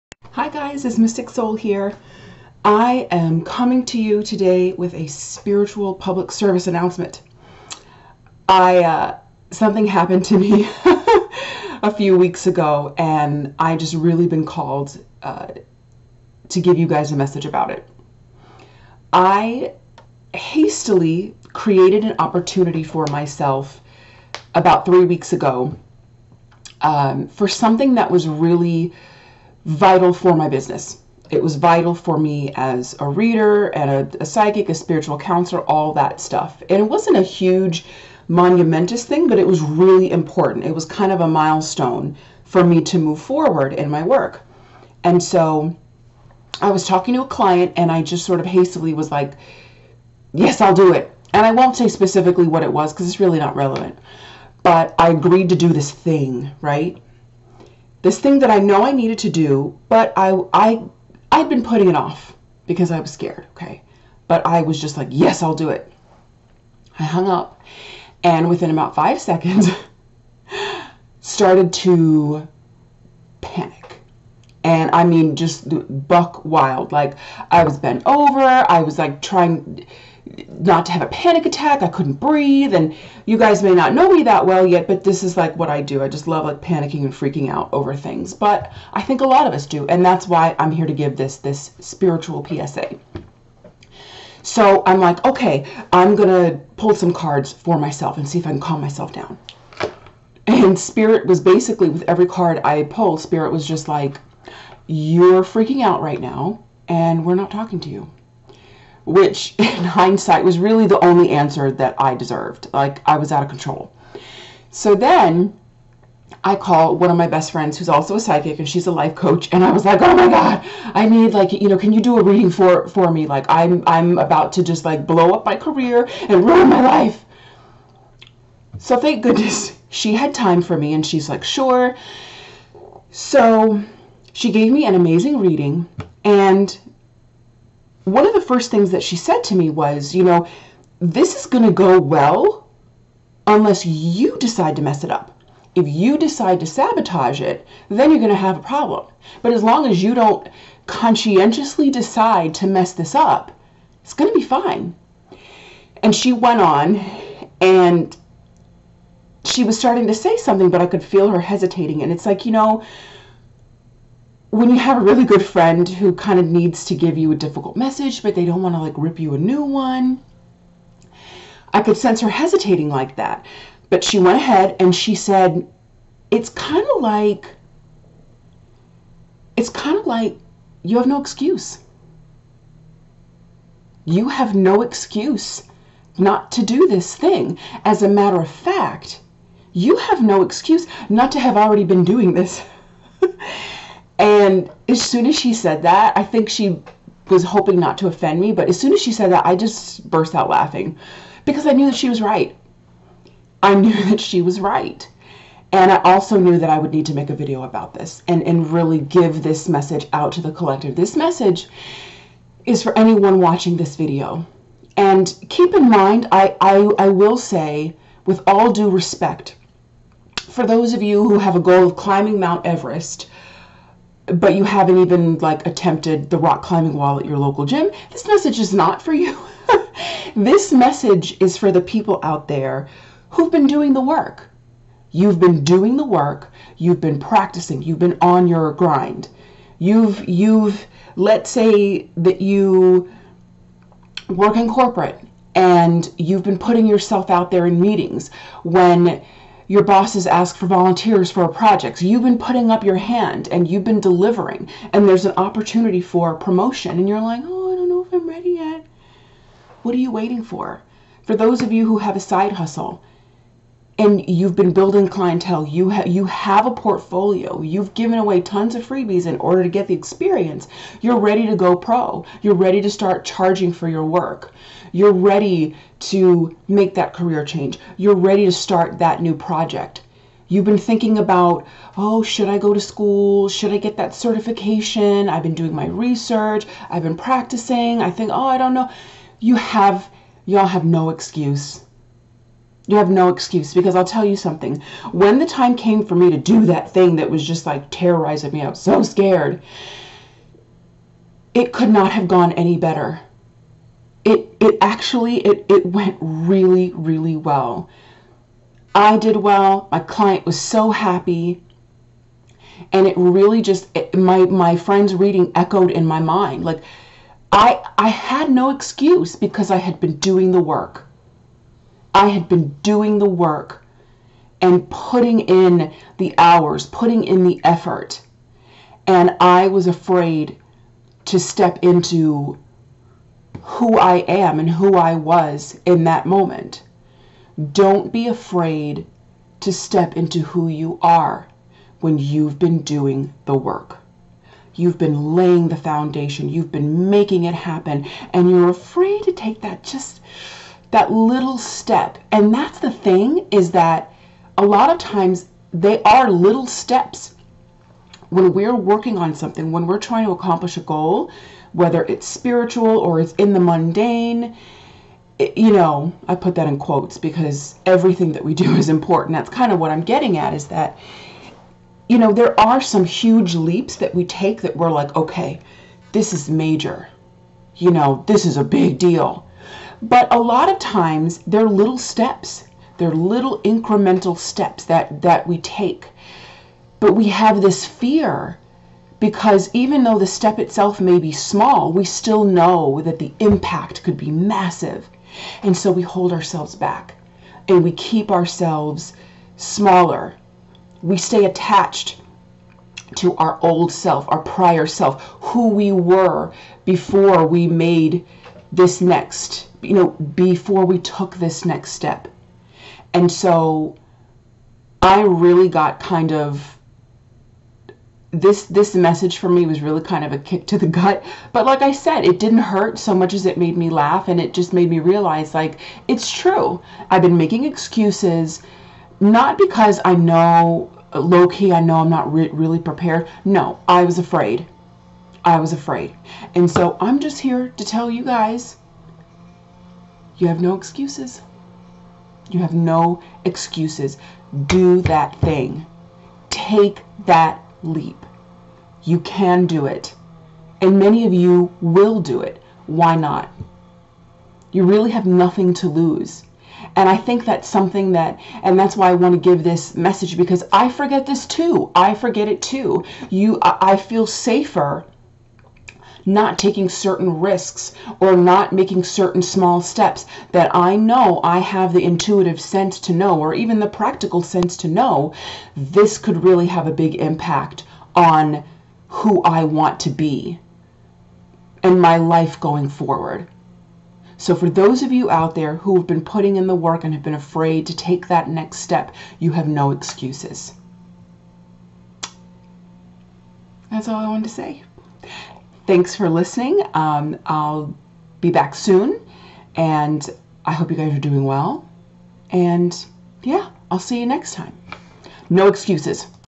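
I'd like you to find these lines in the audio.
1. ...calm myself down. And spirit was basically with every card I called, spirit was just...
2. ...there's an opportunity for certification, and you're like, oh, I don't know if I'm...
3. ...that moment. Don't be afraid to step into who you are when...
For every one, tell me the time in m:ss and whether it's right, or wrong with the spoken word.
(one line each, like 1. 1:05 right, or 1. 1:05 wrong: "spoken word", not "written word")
1. 1:38 wrong: "pulled", not "called"
2. 4:15 wrong: "promotion", not "certification"
3. 5:36 right.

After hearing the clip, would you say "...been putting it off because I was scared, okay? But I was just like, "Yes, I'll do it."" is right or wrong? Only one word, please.
right.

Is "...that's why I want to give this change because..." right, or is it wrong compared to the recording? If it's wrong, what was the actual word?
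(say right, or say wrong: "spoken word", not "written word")
wrong: "message", not "change".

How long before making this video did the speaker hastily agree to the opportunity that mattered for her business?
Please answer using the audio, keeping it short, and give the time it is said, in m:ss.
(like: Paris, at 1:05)
About three weeks ago, at 0:24.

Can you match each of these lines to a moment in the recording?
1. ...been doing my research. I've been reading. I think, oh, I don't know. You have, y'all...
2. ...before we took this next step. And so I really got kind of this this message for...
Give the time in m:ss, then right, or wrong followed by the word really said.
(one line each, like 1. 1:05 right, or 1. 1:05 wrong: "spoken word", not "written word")
1. 4:45 wrong: "practicing", not "reading"
2. 6:50 right.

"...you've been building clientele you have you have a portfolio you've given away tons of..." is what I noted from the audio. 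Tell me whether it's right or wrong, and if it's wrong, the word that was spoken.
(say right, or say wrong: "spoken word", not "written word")
right.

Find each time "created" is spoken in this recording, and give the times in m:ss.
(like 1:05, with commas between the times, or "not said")
0:21.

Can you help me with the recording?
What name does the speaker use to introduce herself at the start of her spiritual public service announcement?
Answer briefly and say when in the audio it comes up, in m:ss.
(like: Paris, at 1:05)
Mystic Soul, at 0:00.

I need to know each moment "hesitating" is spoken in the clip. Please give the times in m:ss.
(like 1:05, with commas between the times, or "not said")
2:41, 2:52.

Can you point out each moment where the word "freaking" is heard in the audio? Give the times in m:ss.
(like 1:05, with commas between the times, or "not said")
1:27, 1:45.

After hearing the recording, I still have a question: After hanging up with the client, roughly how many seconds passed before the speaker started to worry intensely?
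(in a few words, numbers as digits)
5.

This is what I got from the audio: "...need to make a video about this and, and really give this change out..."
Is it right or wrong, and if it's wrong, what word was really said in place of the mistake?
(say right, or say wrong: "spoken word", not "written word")
wrong: "message", not "change".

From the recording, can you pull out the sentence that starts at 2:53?
But she went ahead and she said, It's kind of like, it's kind of like you have no excuse.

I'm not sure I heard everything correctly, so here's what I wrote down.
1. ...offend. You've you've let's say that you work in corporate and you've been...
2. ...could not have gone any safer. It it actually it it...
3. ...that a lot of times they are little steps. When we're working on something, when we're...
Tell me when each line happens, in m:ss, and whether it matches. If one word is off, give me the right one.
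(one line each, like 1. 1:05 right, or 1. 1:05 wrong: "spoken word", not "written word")
1. 3:58 wrong: "grind", not "offend"
2. 5:01 wrong: "better", not "safer"
3. 5:53 right.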